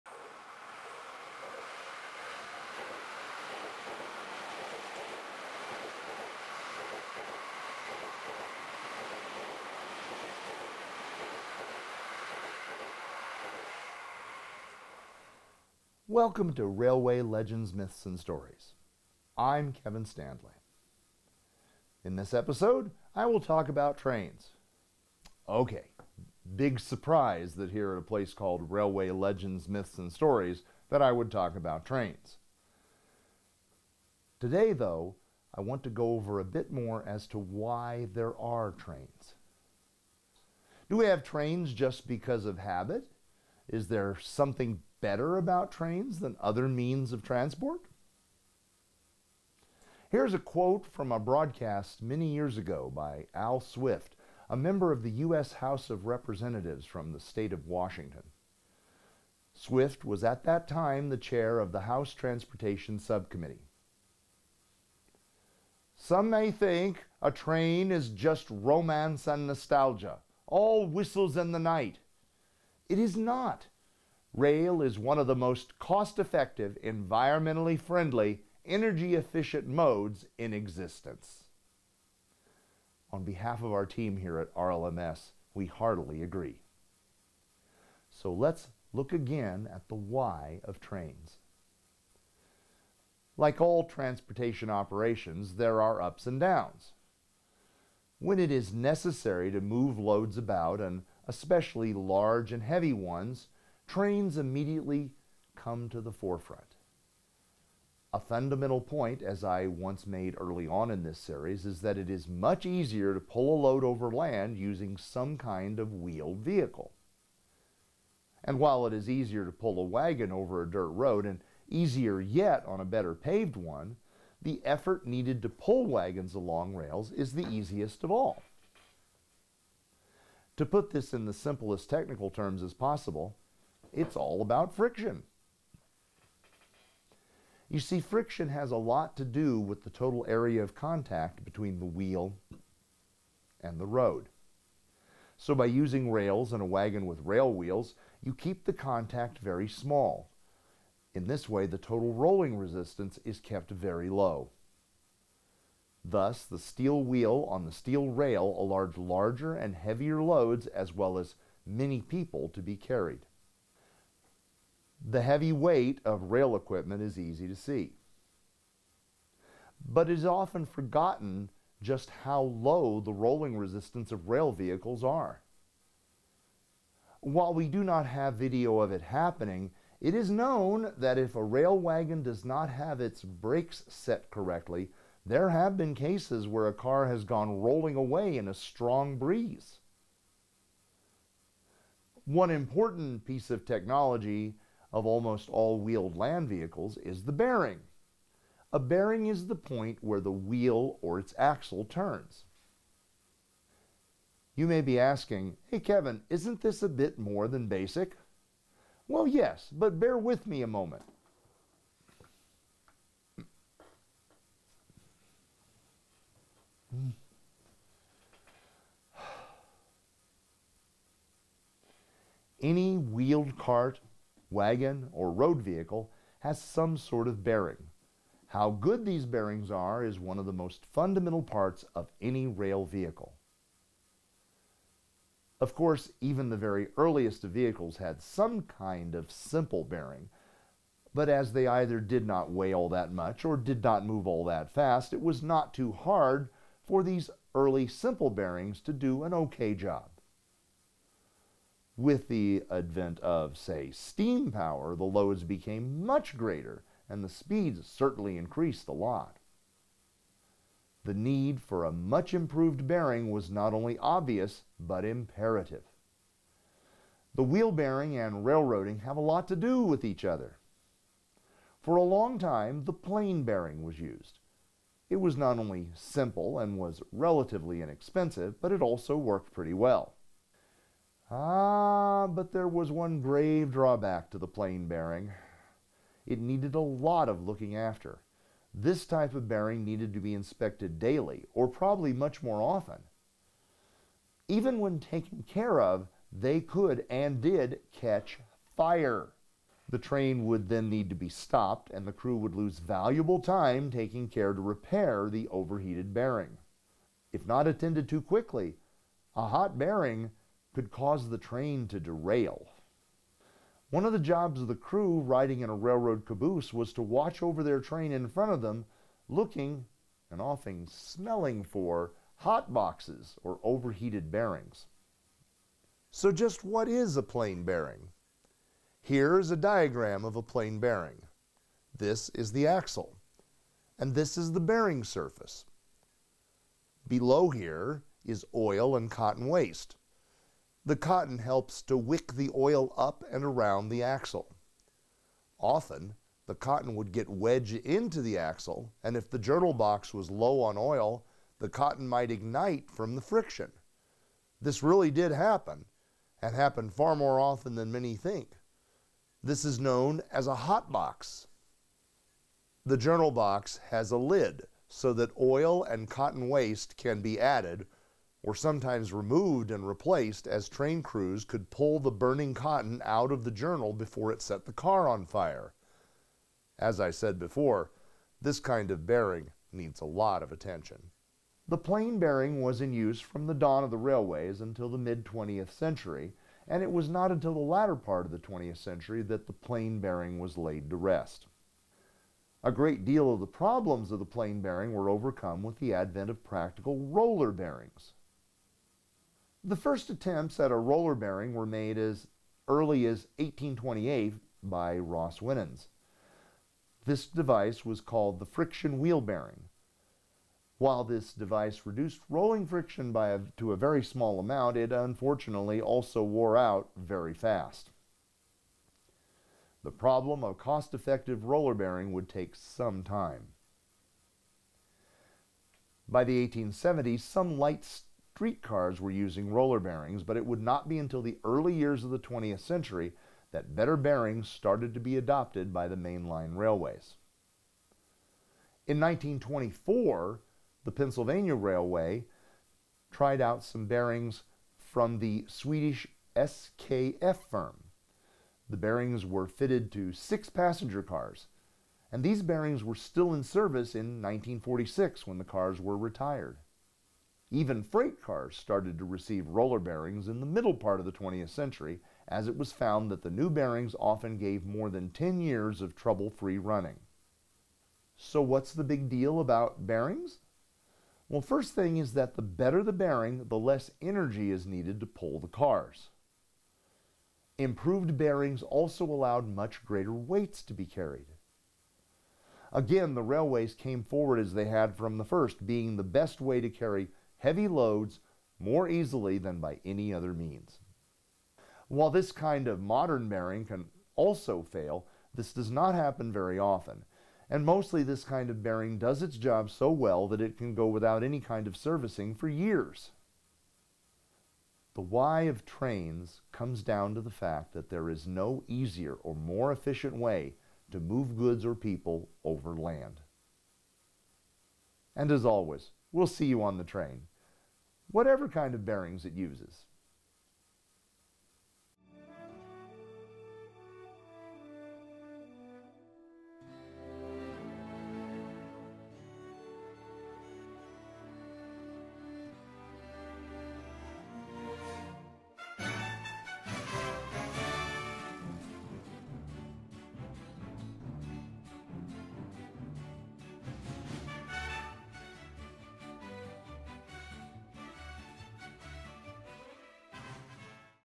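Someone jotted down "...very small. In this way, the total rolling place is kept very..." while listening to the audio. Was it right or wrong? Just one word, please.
wrong.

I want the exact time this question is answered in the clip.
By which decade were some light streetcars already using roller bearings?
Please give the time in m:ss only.
7:06.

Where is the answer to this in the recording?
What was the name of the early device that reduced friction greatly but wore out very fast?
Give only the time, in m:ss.
6:48.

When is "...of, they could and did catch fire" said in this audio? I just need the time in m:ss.
4:55.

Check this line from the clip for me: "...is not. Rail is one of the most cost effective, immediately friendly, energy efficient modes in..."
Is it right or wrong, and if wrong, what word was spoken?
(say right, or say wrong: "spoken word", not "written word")
wrong: "environmentally", not "immediately".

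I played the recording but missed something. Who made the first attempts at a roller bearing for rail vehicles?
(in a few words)
Ross Winans.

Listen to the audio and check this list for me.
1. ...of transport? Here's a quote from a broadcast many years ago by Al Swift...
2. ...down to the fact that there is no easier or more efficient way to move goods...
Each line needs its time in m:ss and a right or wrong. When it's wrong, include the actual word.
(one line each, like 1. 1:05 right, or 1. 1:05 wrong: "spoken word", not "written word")
1. 0:47 right
2. 8:26 right.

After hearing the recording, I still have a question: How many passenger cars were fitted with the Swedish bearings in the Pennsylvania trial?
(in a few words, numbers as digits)
6.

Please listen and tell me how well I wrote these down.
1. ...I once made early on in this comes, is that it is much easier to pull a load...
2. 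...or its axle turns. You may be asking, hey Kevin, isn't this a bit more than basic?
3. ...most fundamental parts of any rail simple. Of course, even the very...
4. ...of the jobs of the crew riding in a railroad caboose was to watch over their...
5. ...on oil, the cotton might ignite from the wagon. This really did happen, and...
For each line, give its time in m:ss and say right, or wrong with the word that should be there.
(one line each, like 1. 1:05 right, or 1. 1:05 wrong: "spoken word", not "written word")
1. 1:49 wrong: "series", not "comes"
2. 3:21 right
3. 3:50 wrong: "vehicle", not "simple"
4. 5:14 right
5. 5:50 wrong: "friction", not "wagon".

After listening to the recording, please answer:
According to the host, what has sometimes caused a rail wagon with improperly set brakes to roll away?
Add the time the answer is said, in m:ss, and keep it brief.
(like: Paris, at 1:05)
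A strong breeze, at 3:08.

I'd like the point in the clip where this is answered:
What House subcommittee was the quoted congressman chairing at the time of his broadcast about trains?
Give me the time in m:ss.
1:01.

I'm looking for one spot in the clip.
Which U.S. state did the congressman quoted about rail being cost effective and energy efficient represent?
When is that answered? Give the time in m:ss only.
0:57.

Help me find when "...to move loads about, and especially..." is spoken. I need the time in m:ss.
1:39.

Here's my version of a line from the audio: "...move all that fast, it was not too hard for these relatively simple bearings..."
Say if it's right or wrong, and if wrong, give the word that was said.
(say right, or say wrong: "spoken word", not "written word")
wrong: "early", not "relatively".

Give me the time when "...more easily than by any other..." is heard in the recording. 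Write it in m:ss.
8:08.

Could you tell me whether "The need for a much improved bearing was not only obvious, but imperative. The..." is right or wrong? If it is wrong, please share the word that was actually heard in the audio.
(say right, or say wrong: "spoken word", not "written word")
right.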